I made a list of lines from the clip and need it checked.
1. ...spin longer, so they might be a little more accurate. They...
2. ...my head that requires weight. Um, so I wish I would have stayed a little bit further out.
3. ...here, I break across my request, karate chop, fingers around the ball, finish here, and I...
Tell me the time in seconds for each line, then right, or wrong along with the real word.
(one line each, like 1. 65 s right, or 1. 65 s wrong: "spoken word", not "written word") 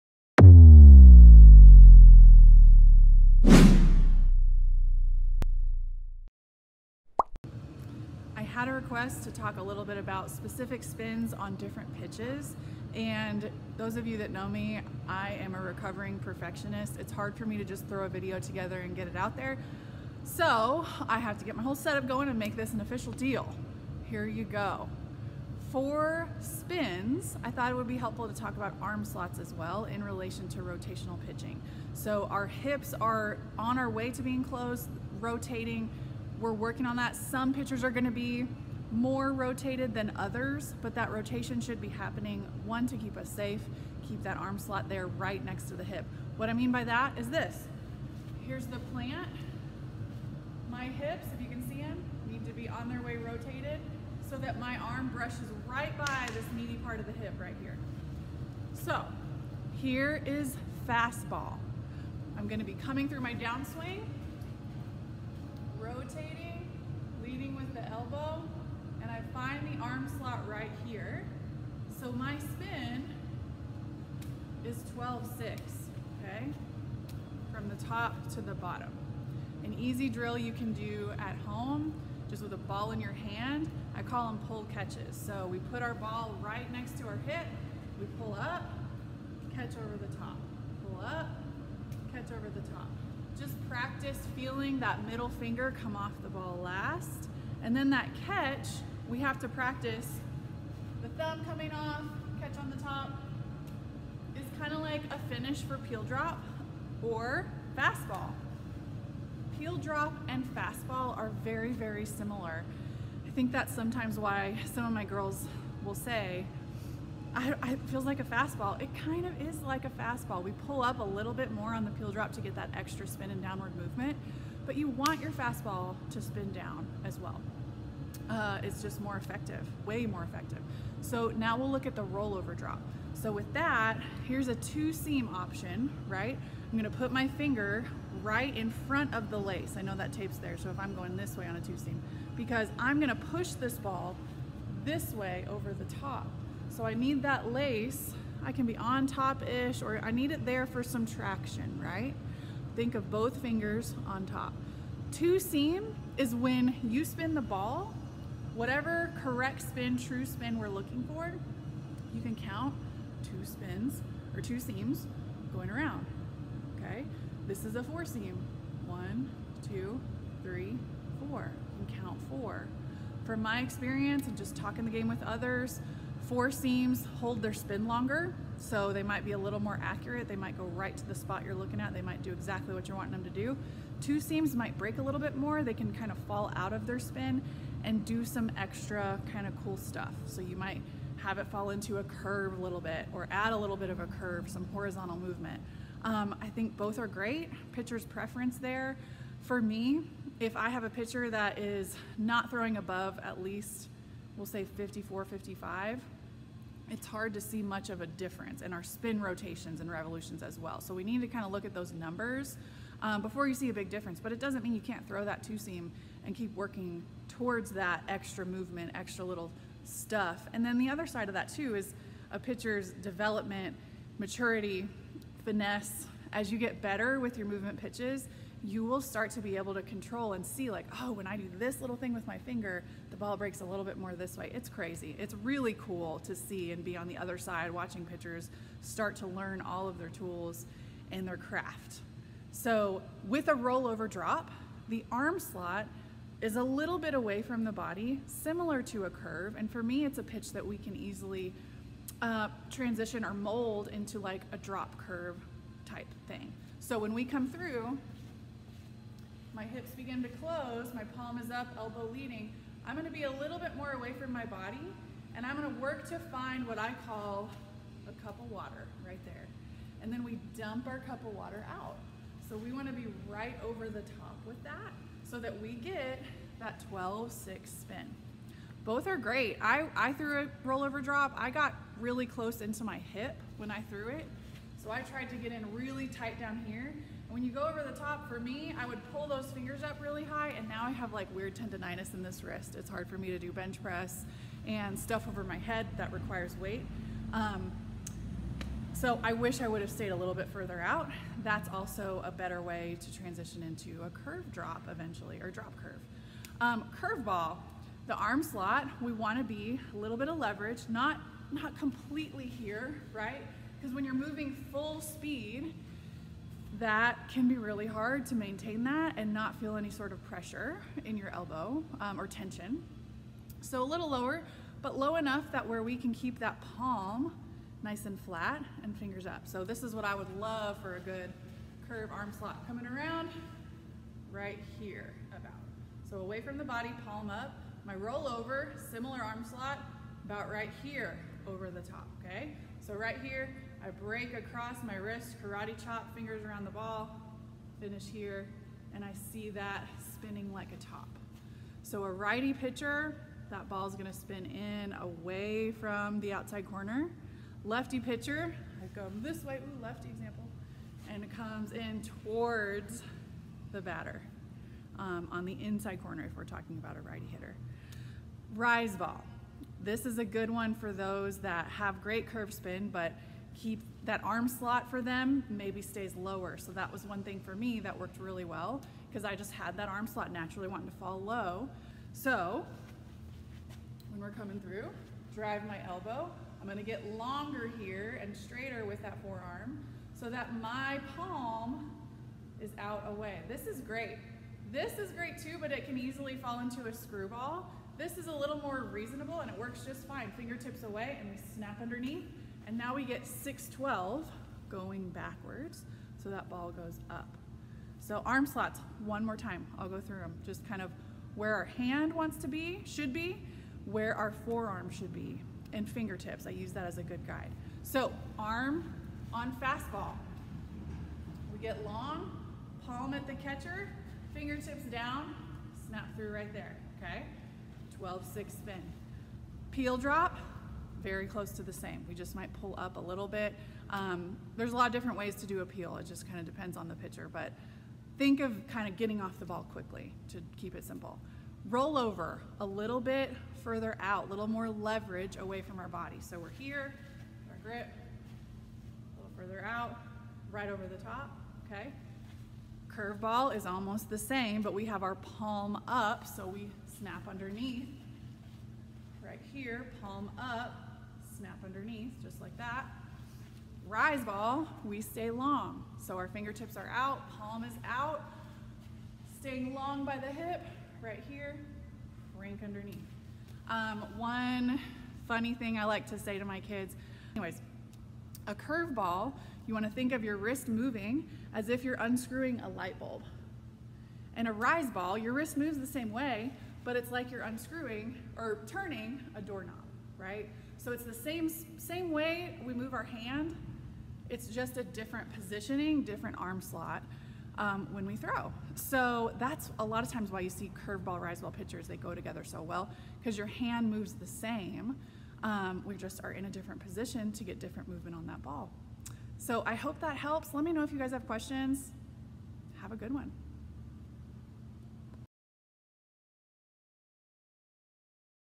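1. 177 s right
2. 295 s right
3. 343 s wrong: "wrist", not "request".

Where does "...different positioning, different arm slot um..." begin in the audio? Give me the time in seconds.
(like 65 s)
494 s.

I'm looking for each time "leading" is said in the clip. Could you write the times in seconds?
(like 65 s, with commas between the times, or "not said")
67 s, 262 s.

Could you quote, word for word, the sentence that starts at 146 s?
So I need that lace, I can be on top-ish, or I need it there for some traction, right?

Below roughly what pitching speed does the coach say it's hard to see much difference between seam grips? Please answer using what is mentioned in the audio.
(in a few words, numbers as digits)
54, 55.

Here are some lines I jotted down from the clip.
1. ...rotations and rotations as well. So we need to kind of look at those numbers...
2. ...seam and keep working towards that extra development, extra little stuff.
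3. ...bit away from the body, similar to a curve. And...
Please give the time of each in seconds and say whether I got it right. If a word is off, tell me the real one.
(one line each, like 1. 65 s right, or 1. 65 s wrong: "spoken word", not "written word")
1. 209 s wrong: "revolutions", not "rotations"
2. 215 s wrong: "movement", not "development"
3. 246 s right.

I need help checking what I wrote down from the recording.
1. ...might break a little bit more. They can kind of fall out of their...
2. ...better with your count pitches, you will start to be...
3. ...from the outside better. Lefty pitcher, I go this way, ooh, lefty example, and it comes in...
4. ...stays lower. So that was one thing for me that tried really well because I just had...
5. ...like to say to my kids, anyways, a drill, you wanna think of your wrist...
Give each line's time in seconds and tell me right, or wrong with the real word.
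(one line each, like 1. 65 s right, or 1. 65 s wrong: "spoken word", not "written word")
1. 184 s right
2. 226 s wrong: "movement", not "count"
3. 355 s wrong: "corner", not "better"
4. 375 s wrong: "worked", not "tried"
5. 475 s wrong: "curveball", not "drill".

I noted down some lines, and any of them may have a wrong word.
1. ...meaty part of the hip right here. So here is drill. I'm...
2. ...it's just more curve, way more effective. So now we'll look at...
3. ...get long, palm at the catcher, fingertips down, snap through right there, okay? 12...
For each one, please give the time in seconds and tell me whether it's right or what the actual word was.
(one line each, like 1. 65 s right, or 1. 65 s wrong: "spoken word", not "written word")
1. 56 s wrong: "fastball", not "drill"
2. 128 s wrong: "effective", not "curve"
3. 421 s right.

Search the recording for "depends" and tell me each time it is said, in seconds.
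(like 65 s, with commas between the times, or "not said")
436 s.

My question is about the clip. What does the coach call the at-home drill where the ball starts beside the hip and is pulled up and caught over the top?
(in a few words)
pull catches.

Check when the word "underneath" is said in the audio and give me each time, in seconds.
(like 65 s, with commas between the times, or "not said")
401 s, 457 s, 461 s, 472 s.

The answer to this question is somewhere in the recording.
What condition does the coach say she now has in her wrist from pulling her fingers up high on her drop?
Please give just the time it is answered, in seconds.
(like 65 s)
291 s.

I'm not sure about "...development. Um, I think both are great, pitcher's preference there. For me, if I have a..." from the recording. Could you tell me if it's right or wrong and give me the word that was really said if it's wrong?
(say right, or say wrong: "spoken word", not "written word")
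wrong: "movement", not "development".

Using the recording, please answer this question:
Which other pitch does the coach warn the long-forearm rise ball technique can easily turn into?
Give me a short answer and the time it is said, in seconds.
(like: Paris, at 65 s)
screwball, at 396 s.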